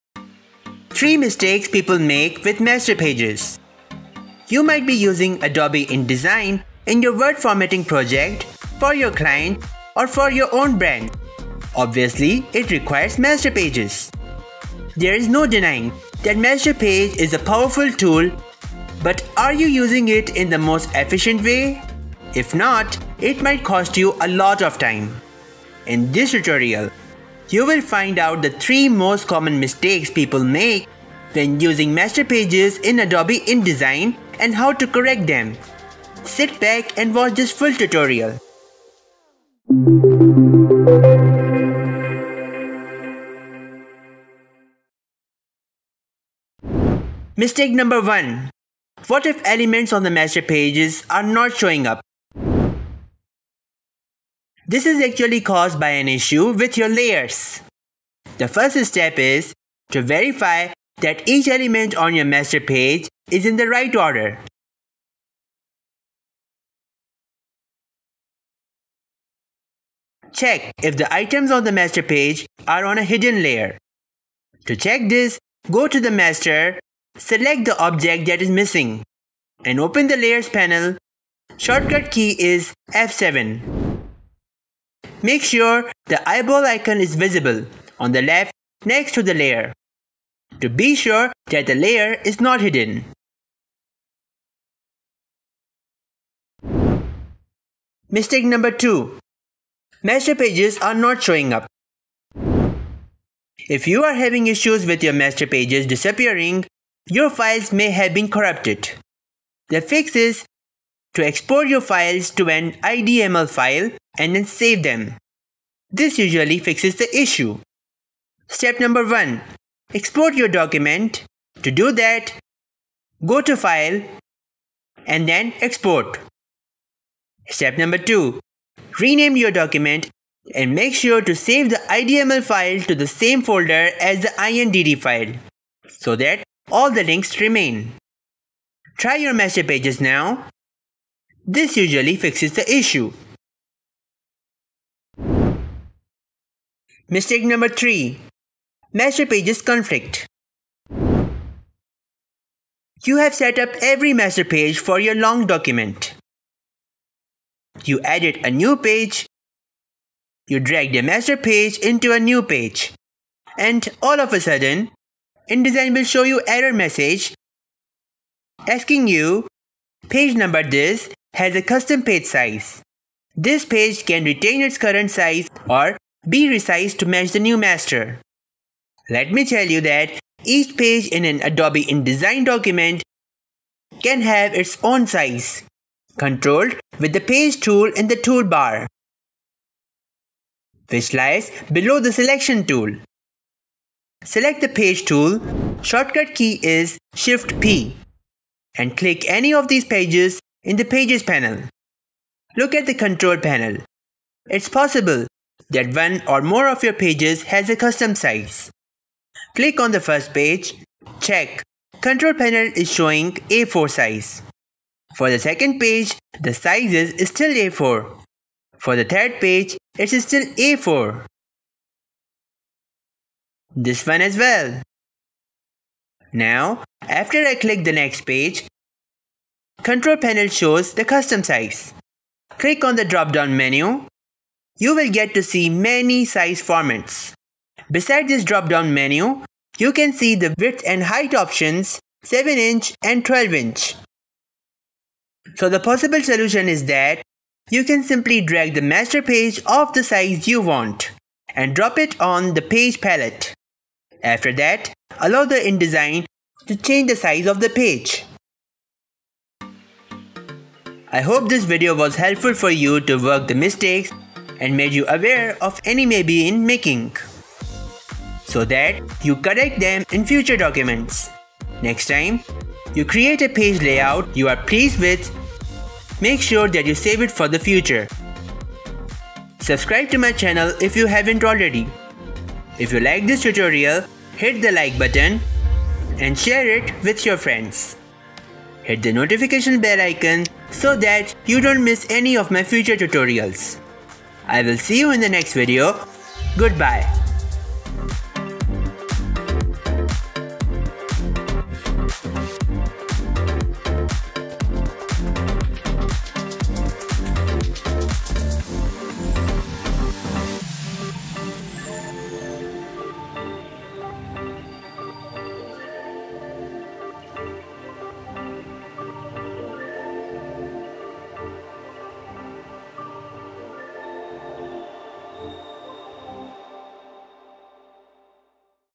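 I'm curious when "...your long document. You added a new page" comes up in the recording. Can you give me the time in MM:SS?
02:34.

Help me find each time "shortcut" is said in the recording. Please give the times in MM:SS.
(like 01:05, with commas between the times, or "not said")
01:21, 03:15.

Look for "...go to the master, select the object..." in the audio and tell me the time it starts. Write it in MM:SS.
01:15.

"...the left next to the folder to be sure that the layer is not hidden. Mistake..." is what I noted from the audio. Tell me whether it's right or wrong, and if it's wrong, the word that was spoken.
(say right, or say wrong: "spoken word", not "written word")
wrong: "layer", not "folder".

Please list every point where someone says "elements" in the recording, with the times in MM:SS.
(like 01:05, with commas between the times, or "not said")
00:49, 01:01.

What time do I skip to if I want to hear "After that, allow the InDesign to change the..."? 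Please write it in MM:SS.
04:14.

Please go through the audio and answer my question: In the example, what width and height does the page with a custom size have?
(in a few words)
7 inch and 12 inch.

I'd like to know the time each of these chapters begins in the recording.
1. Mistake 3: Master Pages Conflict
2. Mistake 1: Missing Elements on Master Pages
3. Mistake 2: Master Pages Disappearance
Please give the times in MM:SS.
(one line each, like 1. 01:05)
1. 02:25
2. 00:46
3. 01:36.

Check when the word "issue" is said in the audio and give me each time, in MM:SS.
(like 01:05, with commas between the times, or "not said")
00:56, 01:44, 01:57, 02:22.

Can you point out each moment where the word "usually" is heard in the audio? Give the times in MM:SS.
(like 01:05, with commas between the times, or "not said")
01:56, 02:21.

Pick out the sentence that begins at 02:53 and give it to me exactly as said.
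This page can retain its current size or be resized to match the new master.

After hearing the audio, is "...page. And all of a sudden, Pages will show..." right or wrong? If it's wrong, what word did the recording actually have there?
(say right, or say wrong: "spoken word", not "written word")
wrong: "InDesign", not "Pages".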